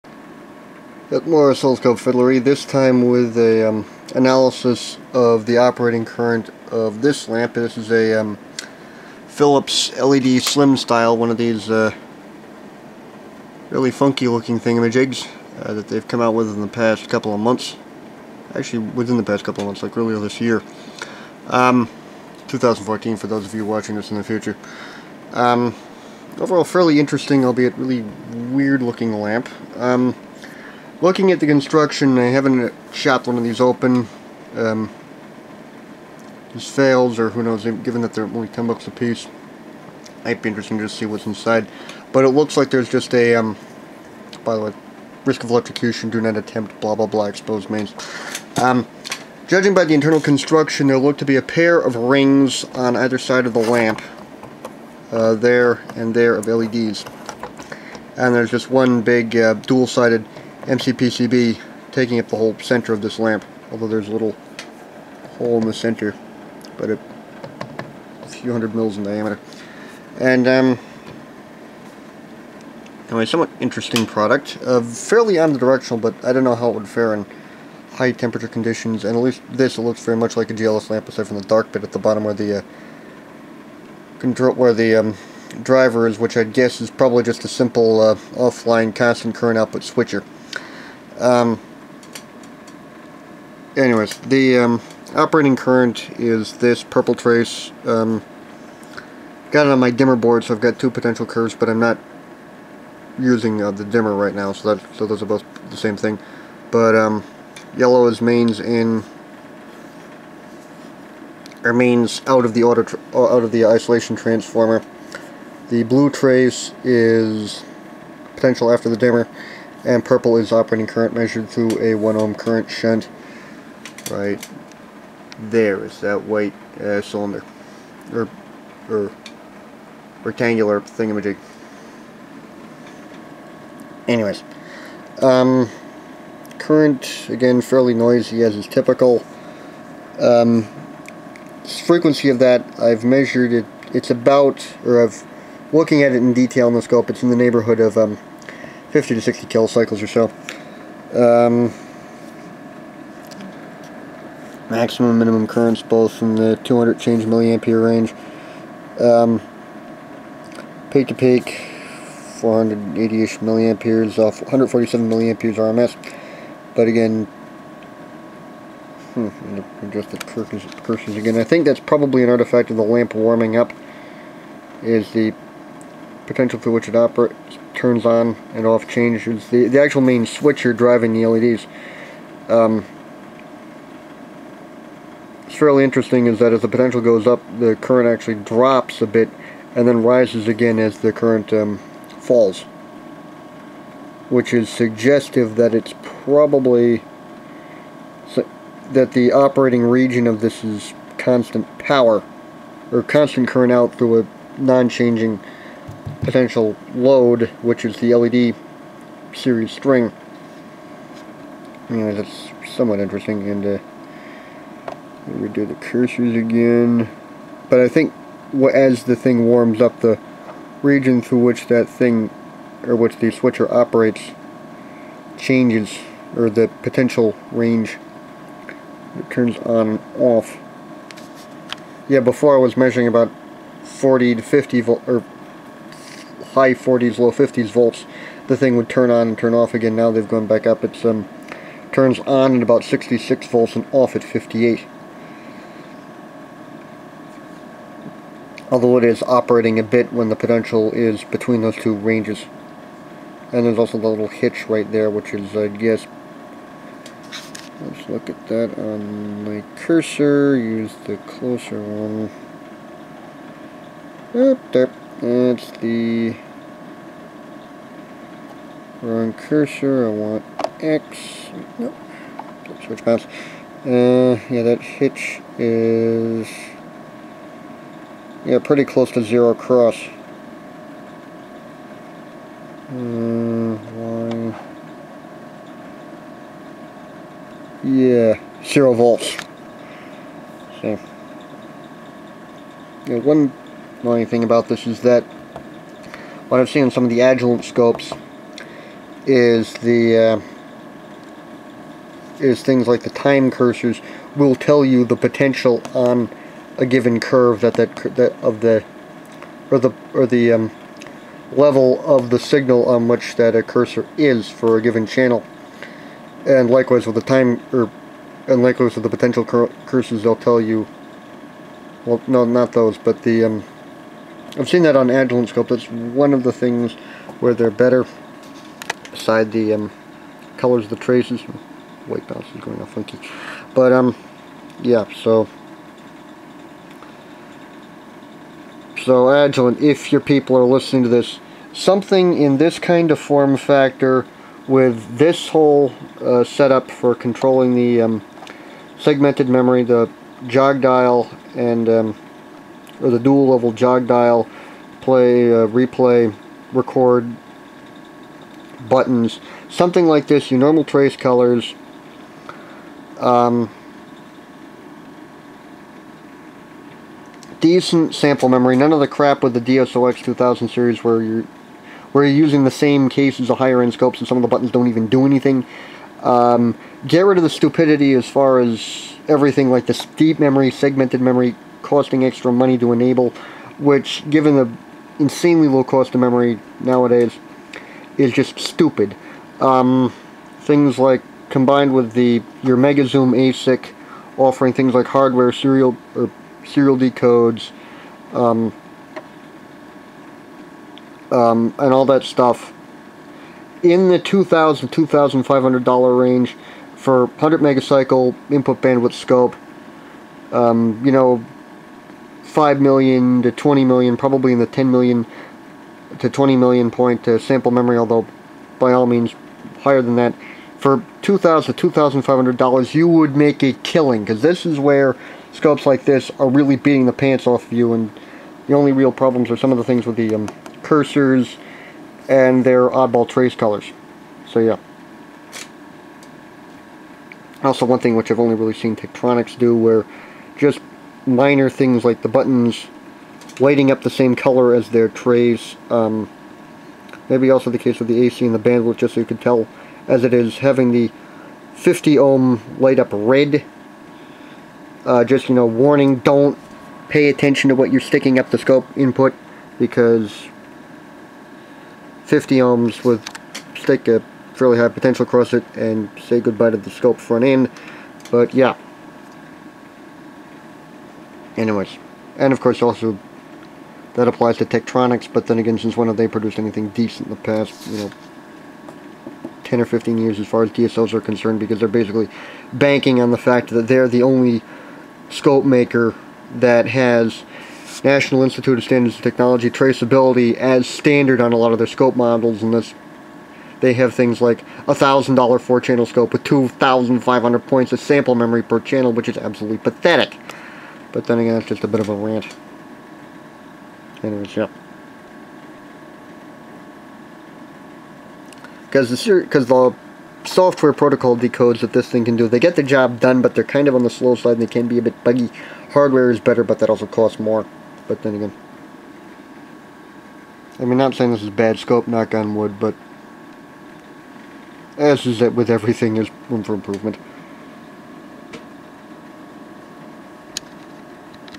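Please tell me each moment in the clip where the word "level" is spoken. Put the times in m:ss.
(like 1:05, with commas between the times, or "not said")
5:11, 5:53.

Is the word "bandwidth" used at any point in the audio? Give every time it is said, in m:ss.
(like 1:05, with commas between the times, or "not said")
6:48, 7:28.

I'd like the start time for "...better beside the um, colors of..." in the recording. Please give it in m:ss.
5:27.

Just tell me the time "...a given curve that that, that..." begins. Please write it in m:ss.
5:06.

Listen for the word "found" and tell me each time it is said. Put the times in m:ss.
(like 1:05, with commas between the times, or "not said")
not said.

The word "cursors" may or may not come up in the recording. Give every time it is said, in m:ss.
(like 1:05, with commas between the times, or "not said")
2:50, 3:35, 4:19, 4:29, 5:03, 5:13, 5:19, 7:10.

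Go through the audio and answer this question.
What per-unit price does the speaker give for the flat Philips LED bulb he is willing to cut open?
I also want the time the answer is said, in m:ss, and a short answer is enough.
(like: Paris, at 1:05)
10 bucks, at 0:38.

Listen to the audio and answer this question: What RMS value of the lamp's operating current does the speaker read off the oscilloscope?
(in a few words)
147 milliamperes.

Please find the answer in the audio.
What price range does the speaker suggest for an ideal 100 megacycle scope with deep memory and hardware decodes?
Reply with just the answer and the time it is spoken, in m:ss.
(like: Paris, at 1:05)
$2,000 to $2,500, at 6:44.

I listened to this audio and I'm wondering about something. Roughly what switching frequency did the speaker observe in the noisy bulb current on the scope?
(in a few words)
50 to 60 kilocycles.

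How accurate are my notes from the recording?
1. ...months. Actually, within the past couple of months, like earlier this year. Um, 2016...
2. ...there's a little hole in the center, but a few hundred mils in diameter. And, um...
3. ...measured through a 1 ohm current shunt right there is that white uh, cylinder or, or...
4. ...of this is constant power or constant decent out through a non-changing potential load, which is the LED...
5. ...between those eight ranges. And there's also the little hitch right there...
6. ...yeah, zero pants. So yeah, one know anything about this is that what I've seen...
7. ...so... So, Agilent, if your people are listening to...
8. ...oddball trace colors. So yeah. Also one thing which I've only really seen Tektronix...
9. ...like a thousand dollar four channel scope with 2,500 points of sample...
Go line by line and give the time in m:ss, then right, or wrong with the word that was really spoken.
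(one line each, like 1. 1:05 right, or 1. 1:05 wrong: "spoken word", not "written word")
1. 0:17 wrong: "2014", not "2016"
2. 1:03 right
3. 2:01 right
4. 3:20 wrong: "current", not "decent"
5. 4:11 wrong: "two", not "eight"
6. 4:47 wrong: "volts", not "pants"
7. 5:35 right
8. 7:12 right
9. 8:14 right.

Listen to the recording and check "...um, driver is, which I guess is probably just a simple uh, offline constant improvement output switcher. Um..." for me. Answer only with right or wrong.
wrong.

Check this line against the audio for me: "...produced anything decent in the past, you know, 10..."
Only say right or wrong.
right.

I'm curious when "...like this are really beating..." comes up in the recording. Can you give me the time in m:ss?
7:05.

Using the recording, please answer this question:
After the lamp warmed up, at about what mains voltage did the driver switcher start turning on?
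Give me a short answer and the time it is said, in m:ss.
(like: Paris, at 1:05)
66 volts, at 4:02.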